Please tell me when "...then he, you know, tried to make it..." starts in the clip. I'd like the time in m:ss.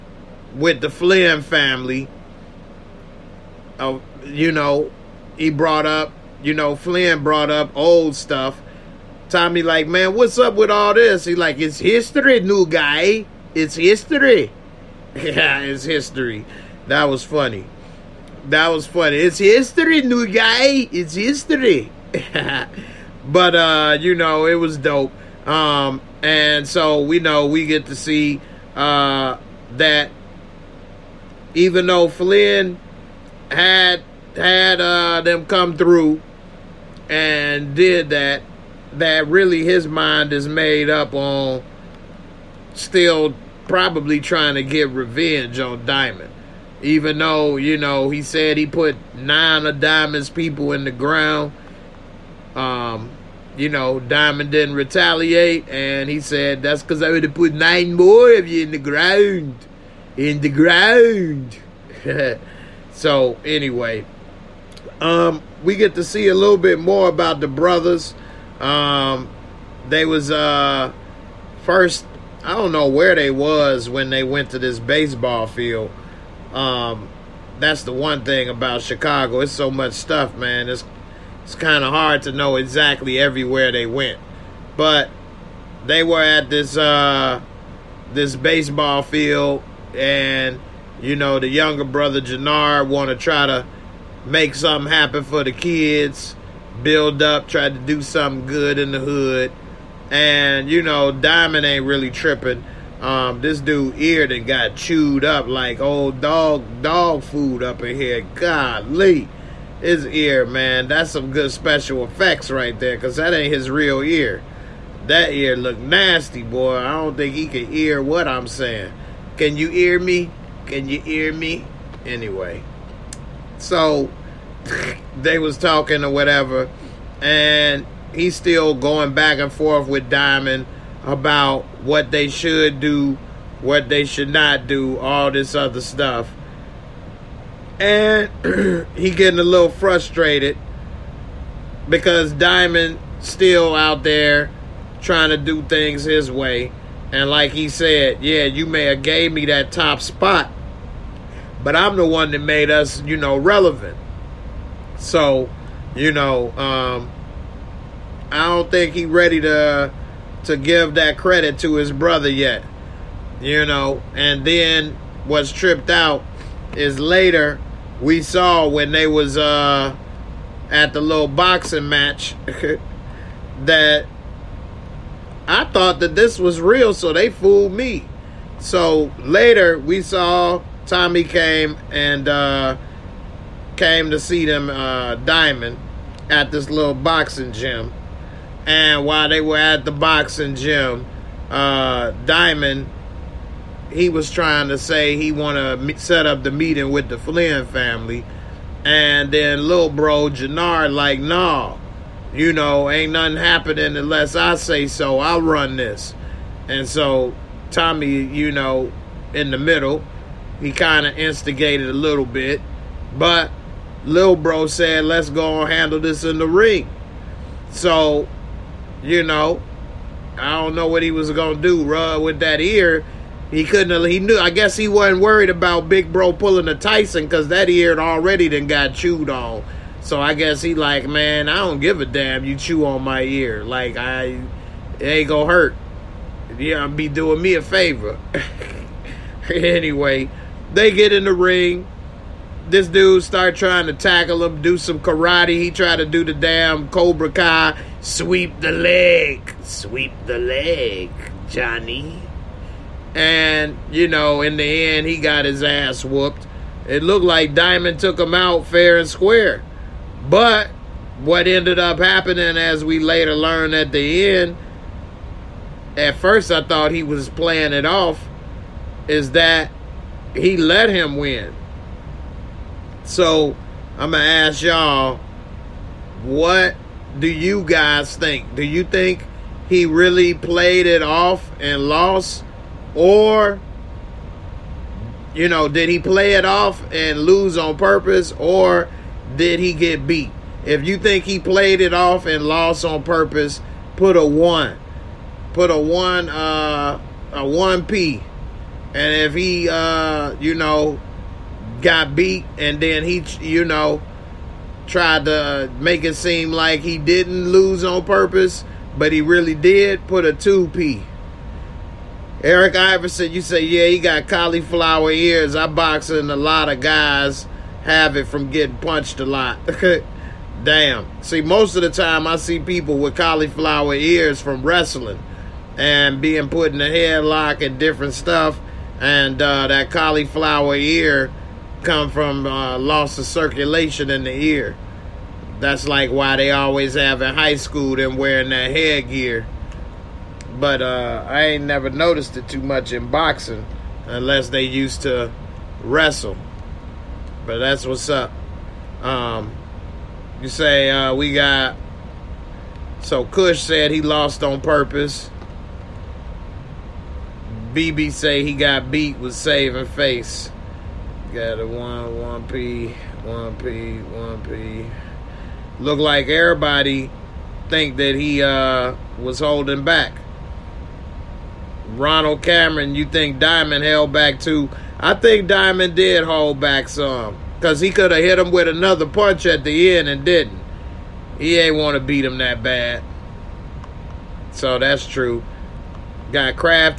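5:02.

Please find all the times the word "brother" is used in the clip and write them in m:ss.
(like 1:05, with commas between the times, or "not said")
1:07, 1:31, 2:41.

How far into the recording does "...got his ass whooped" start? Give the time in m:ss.
4:15.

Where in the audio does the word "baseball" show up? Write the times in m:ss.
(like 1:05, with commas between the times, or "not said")
1:14, 1:28.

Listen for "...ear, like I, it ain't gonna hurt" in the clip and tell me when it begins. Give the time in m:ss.
3:53.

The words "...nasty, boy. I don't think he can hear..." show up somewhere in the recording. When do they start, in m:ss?
1:55.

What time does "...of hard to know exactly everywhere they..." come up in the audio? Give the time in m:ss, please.
1:21.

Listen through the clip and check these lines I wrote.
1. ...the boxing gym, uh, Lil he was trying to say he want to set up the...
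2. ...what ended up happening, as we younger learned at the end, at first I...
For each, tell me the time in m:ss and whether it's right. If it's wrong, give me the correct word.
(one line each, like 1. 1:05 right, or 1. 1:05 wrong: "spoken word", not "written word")
1. 3:09 wrong: "Diamond", not "Lil"
2. 4:21 wrong: "later", not "younger".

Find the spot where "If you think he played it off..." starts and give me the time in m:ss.
4:50.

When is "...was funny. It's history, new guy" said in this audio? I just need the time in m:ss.
0:18.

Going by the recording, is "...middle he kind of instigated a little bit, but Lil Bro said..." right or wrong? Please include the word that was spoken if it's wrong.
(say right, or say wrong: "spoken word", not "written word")
right.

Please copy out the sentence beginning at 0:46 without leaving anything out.
Even though, you know, he said he put nine of Diamond's people in the ground.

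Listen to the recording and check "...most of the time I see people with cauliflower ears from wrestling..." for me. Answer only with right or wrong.
right.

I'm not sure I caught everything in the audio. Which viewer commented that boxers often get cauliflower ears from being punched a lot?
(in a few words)
Eric Iverson.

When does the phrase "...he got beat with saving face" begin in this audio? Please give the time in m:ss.
5:58.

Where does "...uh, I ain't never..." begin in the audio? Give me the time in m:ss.
5:40.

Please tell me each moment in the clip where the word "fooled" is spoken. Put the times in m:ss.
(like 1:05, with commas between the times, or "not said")
2:57.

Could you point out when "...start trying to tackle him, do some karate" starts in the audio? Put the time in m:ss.
4:03.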